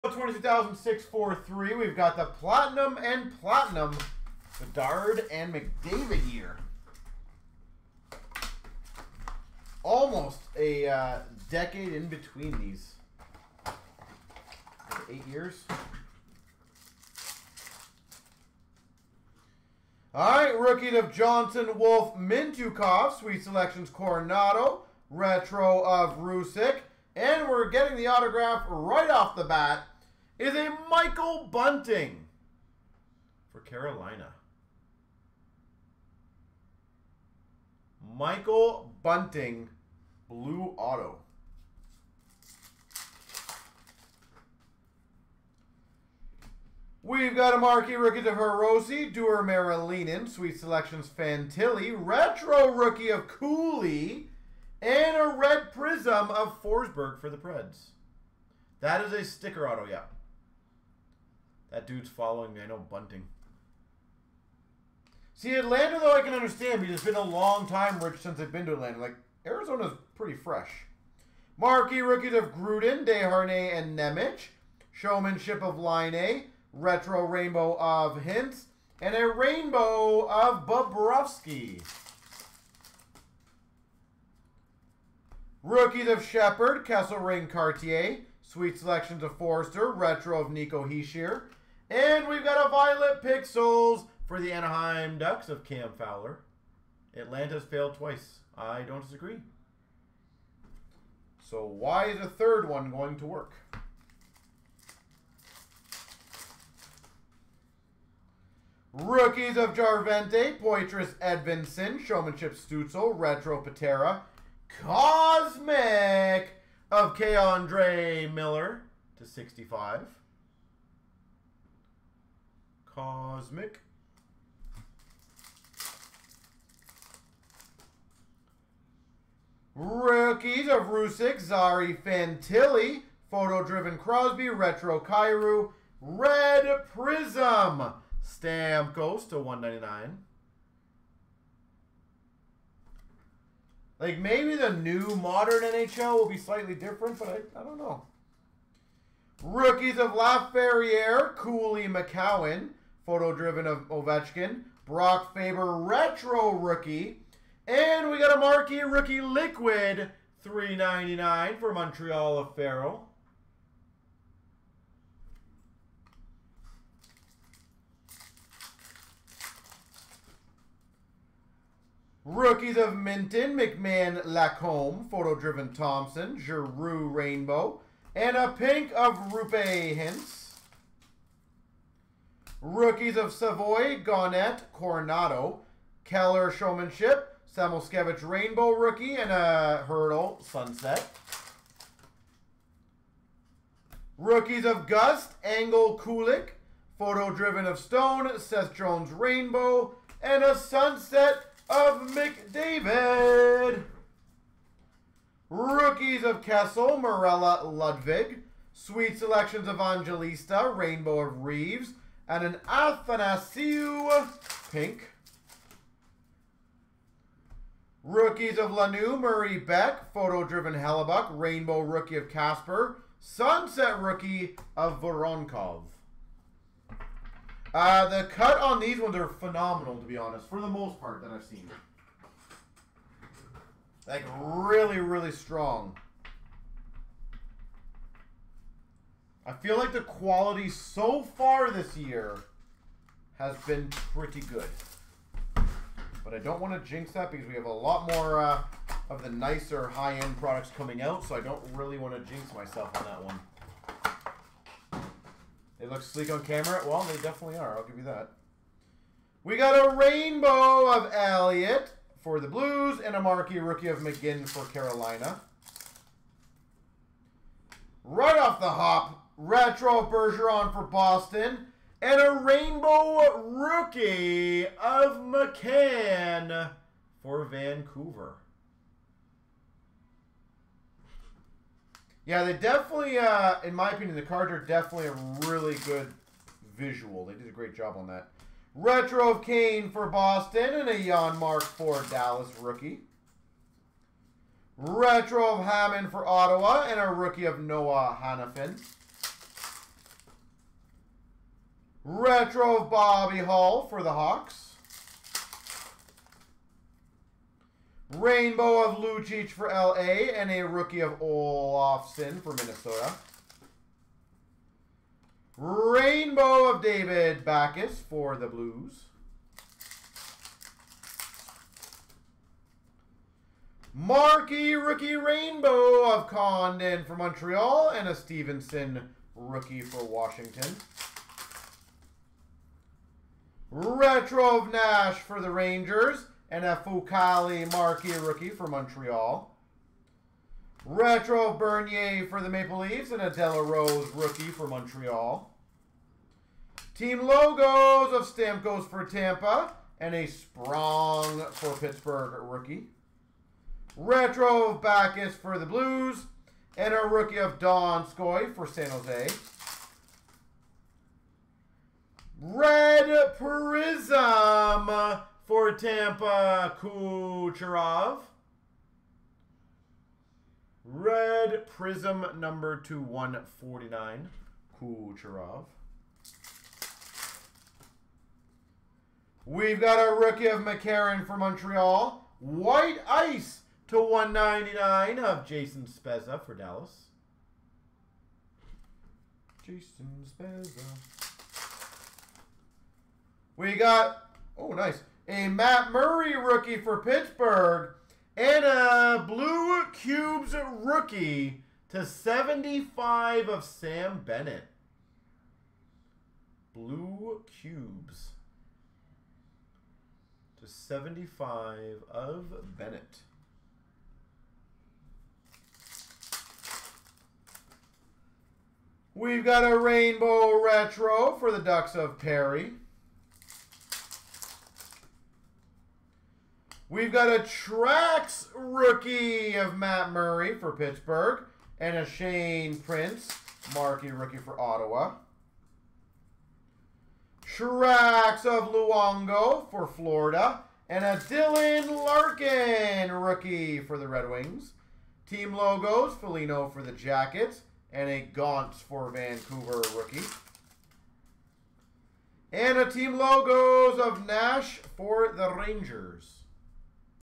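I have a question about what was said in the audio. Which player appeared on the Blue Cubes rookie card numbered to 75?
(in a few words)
Sam Bennett.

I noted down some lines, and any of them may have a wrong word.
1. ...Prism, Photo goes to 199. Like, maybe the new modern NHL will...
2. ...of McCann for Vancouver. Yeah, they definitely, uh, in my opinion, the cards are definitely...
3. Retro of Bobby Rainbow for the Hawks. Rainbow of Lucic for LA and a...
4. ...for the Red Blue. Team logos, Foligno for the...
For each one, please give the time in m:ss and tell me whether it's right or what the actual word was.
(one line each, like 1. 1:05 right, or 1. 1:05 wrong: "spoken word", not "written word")
1. 2:16 wrong: "Stamp", not "Photo"
2. 4:34 right
3. 5:02 wrong: "Hall", not "Rainbow"
4. 7:23 wrong: "Wings", not "Blue".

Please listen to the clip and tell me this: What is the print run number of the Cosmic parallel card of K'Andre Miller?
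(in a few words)
65.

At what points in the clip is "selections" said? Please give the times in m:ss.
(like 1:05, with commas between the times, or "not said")
0:23, 0:50, 1:28, 3:29.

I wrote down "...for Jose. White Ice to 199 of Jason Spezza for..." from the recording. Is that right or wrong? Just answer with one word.
wrong.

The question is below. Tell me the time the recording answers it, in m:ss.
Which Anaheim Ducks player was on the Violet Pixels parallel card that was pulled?
1:35.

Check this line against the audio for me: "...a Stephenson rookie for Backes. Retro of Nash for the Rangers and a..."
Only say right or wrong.
wrong.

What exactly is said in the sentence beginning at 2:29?
Rookies of LaFerriere, Cooley McCowan, Photo driven of Ovechkin.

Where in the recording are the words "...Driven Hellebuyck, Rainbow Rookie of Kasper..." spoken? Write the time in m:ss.
3:40.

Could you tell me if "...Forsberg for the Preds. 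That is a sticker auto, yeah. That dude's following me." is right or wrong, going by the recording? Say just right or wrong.
right.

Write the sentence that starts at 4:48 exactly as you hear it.
Retro of Kane for Boston and a Janmark for Dallas rookie.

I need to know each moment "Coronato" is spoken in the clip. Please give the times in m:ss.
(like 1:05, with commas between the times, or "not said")
0:23, 3:04.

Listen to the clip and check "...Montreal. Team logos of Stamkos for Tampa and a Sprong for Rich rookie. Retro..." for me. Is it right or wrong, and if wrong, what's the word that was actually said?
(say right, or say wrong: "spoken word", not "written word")
wrong: "Pittsburgh", not "Rich".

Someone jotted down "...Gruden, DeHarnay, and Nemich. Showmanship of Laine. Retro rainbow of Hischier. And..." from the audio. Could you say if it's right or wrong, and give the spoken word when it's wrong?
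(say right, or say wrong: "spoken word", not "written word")
wrong: "Hintz", not "Hischier".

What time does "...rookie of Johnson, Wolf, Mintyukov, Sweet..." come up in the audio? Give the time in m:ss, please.
0:20.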